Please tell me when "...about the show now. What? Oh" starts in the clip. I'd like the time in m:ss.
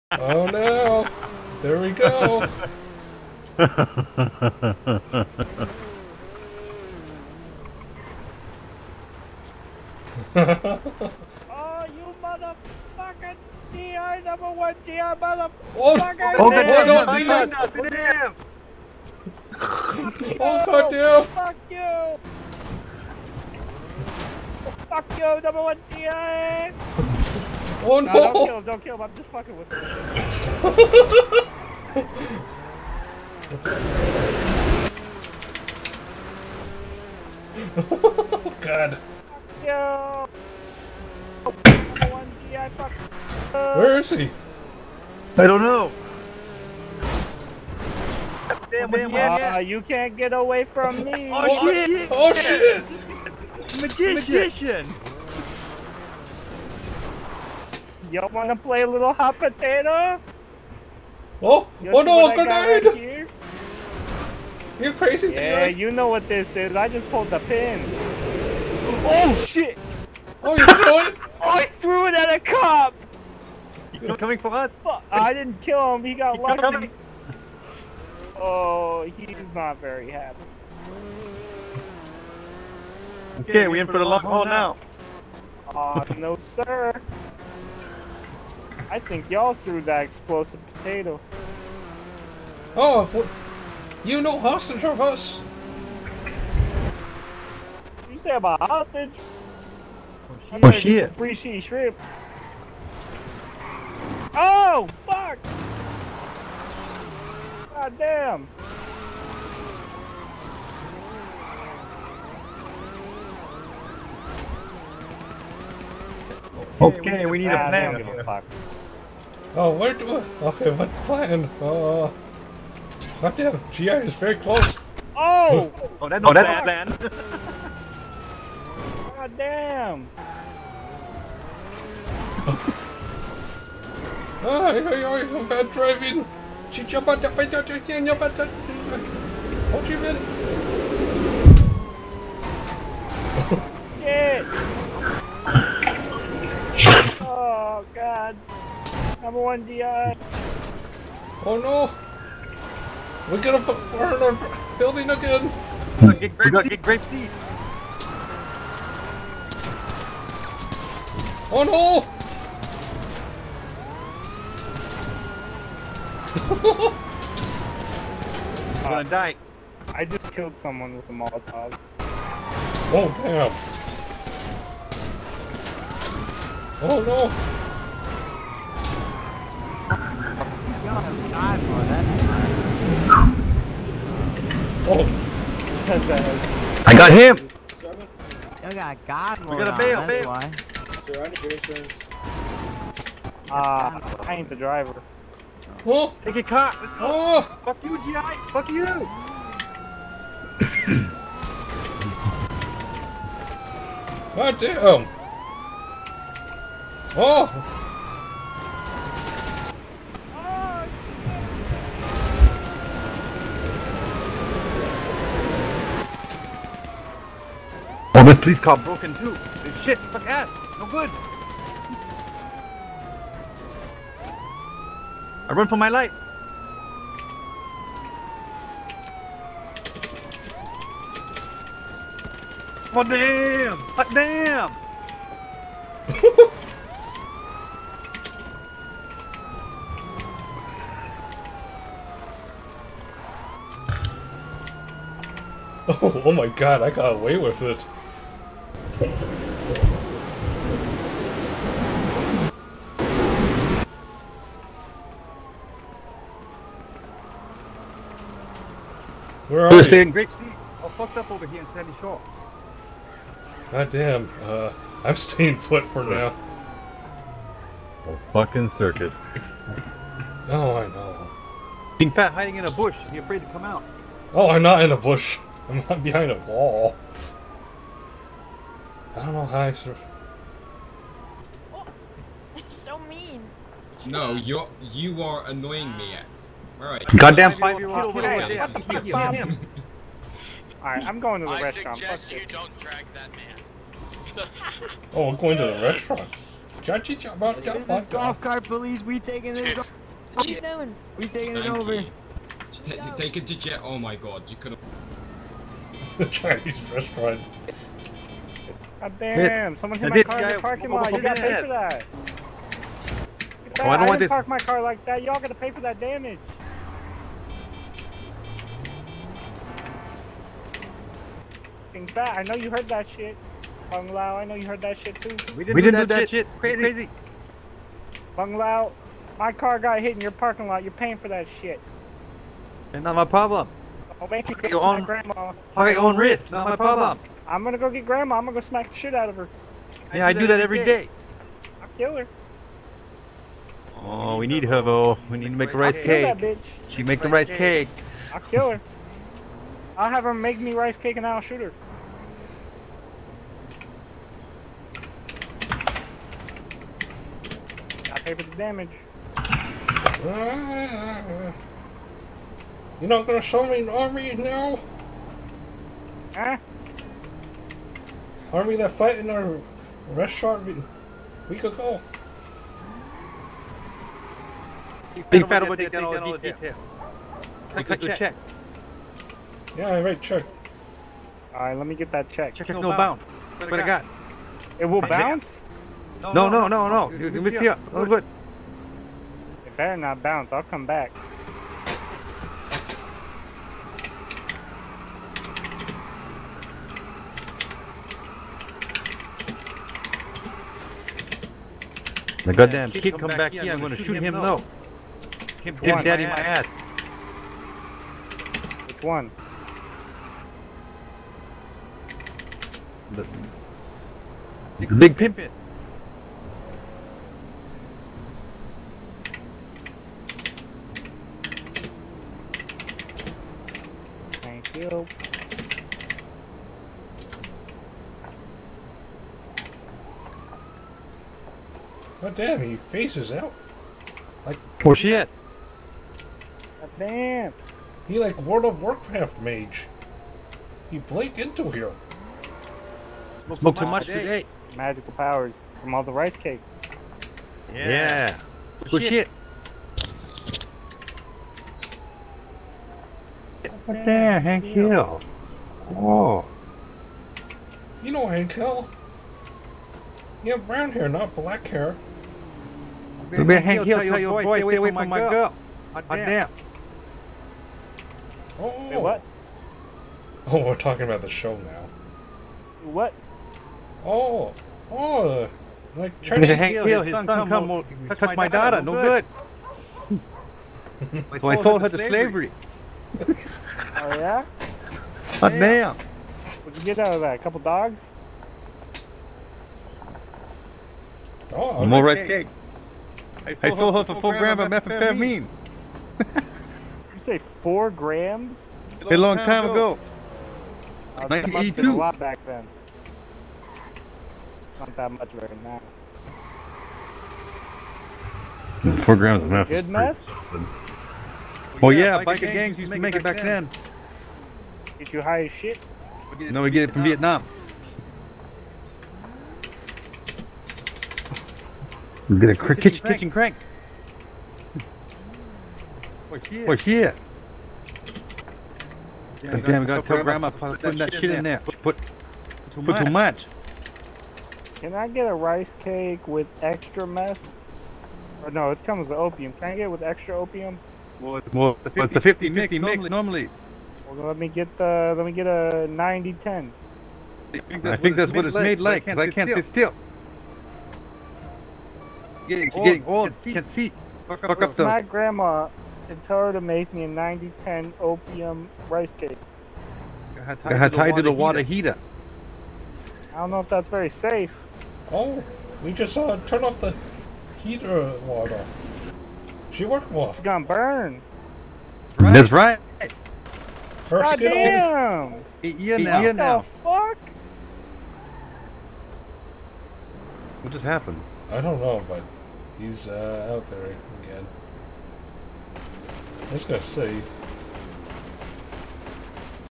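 7:51.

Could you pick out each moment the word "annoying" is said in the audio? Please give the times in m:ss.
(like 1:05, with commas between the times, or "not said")
4:45.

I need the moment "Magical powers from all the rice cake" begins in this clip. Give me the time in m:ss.
7:24.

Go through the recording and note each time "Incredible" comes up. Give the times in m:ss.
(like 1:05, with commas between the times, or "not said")
6:15.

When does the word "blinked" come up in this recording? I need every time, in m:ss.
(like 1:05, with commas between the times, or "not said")
7:20.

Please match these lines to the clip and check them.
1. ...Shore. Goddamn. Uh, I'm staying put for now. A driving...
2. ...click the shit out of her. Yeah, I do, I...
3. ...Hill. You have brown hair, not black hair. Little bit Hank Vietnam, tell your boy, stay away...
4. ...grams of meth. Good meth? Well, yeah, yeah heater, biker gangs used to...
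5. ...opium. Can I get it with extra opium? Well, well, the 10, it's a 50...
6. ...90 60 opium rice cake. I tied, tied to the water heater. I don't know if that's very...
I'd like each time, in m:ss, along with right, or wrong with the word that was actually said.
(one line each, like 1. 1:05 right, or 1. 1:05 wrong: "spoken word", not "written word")
1. 4:21 wrong: "fucking", not "driving"
2. 5:38 wrong: "smack", not "click"
3. 7:38 wrong: "Hill", not "Vietnam"
4. 8:29 wrong: "biker", not "heater"
5. 8:59 wrong: "50", not "10"
6. 9:17 wrong: "10", not "60".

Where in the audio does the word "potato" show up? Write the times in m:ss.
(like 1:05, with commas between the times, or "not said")
0:59, 1:30.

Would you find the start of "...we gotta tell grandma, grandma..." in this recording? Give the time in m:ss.
8:49.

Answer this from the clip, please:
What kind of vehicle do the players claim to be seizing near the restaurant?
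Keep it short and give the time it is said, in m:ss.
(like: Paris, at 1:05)
golf cart police, at 4:58.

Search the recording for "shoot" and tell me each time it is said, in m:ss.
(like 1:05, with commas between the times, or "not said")
5:51, 6:43.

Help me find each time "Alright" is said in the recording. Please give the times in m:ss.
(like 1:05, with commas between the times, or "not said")
4:48, 6:21.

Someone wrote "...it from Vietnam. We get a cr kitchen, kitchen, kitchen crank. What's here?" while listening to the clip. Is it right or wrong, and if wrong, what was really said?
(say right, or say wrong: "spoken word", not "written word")
right.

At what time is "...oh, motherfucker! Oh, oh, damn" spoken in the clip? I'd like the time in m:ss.
0:15.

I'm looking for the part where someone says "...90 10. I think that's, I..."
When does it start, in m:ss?
9:05.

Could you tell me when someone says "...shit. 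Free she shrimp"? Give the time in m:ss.
1:40.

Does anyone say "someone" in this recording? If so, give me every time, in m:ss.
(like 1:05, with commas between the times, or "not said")
2:50, 5:09.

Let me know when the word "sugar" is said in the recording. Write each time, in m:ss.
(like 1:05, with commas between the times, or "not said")
not said.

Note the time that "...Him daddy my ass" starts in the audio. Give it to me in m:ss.
6:45.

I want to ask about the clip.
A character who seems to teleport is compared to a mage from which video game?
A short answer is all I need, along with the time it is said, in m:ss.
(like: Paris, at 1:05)
World of Warcraft, at 7:18.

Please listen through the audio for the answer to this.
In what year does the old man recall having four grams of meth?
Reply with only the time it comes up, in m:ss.
8:21.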